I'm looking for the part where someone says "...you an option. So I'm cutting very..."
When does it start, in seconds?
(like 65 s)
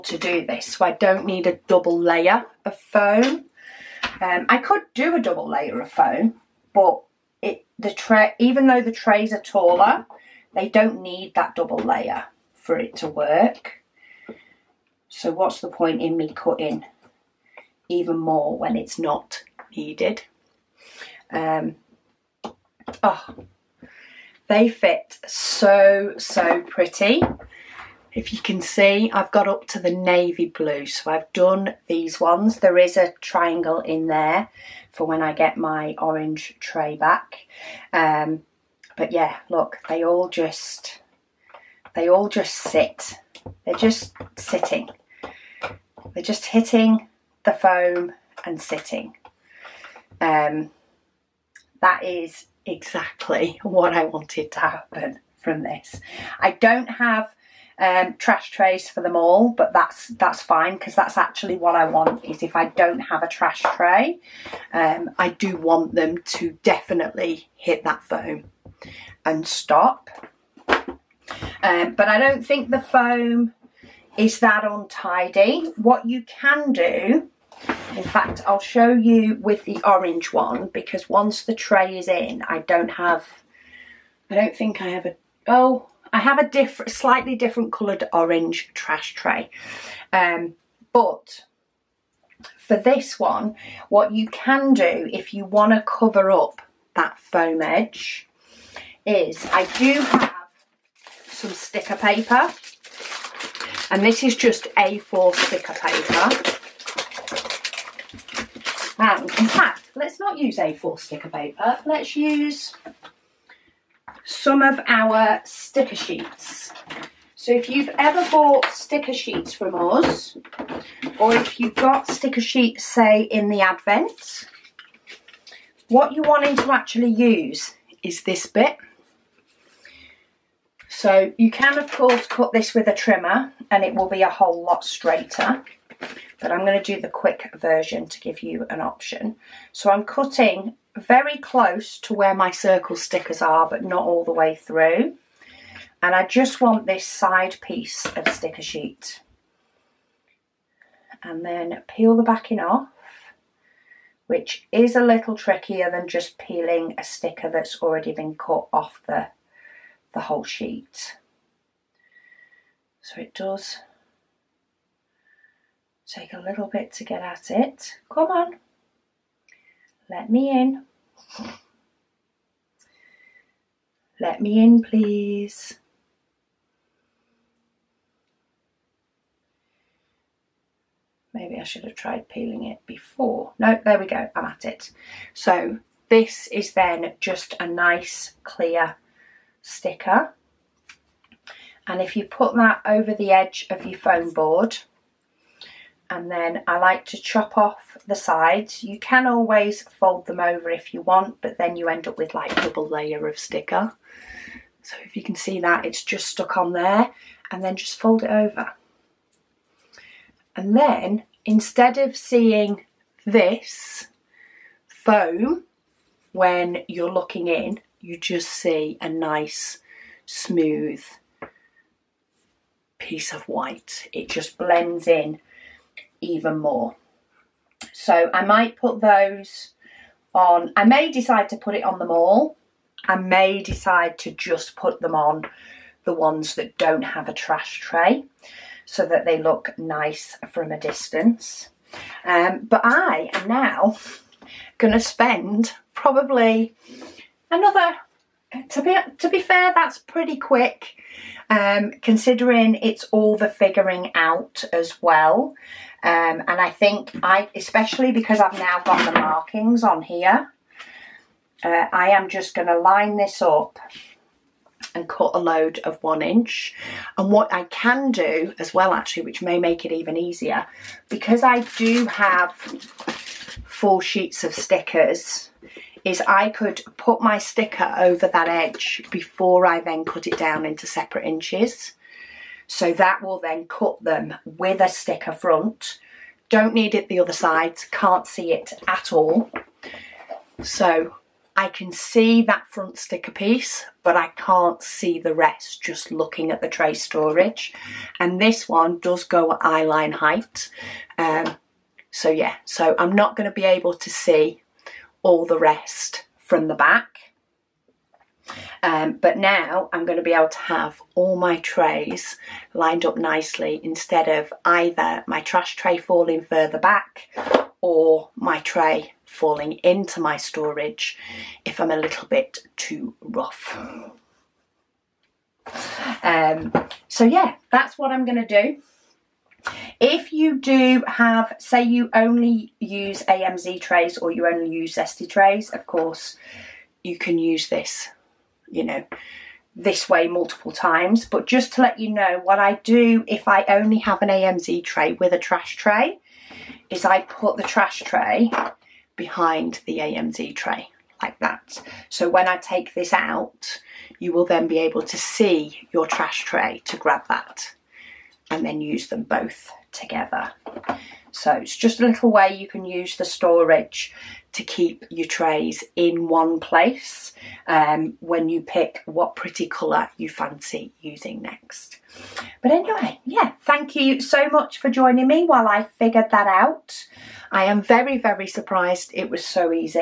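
138 s.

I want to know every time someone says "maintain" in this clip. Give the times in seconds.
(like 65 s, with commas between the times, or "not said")
not said.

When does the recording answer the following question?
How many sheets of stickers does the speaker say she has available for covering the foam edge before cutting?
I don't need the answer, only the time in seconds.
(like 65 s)
273 s.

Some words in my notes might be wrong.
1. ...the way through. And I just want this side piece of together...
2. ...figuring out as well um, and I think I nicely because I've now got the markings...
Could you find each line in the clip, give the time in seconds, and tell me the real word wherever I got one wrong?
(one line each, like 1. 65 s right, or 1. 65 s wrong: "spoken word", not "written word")
1. 144 s wrong: "sticker", not "together"
2. 253 s wrong: "especially", not "nicely".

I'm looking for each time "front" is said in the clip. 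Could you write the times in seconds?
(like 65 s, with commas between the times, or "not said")
285 s, 292 s.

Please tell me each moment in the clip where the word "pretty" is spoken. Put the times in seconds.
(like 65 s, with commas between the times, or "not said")
26 s, 249 s, 369 s.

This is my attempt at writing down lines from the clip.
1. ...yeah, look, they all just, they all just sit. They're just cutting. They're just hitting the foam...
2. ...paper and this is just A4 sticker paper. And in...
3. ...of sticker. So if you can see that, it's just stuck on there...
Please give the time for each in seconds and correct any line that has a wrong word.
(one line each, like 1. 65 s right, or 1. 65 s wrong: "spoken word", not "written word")
1. 39 s wrong: "sitting", not "cutting"
2. 101 s right
3. 203 s right.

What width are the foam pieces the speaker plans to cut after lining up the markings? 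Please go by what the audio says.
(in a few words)
1 inch.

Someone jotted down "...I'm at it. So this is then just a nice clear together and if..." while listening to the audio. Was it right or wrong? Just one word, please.
wrong.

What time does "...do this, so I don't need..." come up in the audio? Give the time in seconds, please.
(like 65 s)
0 s.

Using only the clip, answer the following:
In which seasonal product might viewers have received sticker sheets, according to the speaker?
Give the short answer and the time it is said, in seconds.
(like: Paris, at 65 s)
The Advent, at 123 s.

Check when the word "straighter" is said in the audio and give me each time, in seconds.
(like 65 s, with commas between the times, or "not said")
134 s.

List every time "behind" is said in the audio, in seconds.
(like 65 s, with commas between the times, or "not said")
349 s.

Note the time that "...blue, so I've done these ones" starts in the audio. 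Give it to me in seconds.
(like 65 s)
30 s.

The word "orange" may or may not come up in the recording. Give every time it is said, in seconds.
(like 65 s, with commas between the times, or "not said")
35 s, 79 s, 88 s.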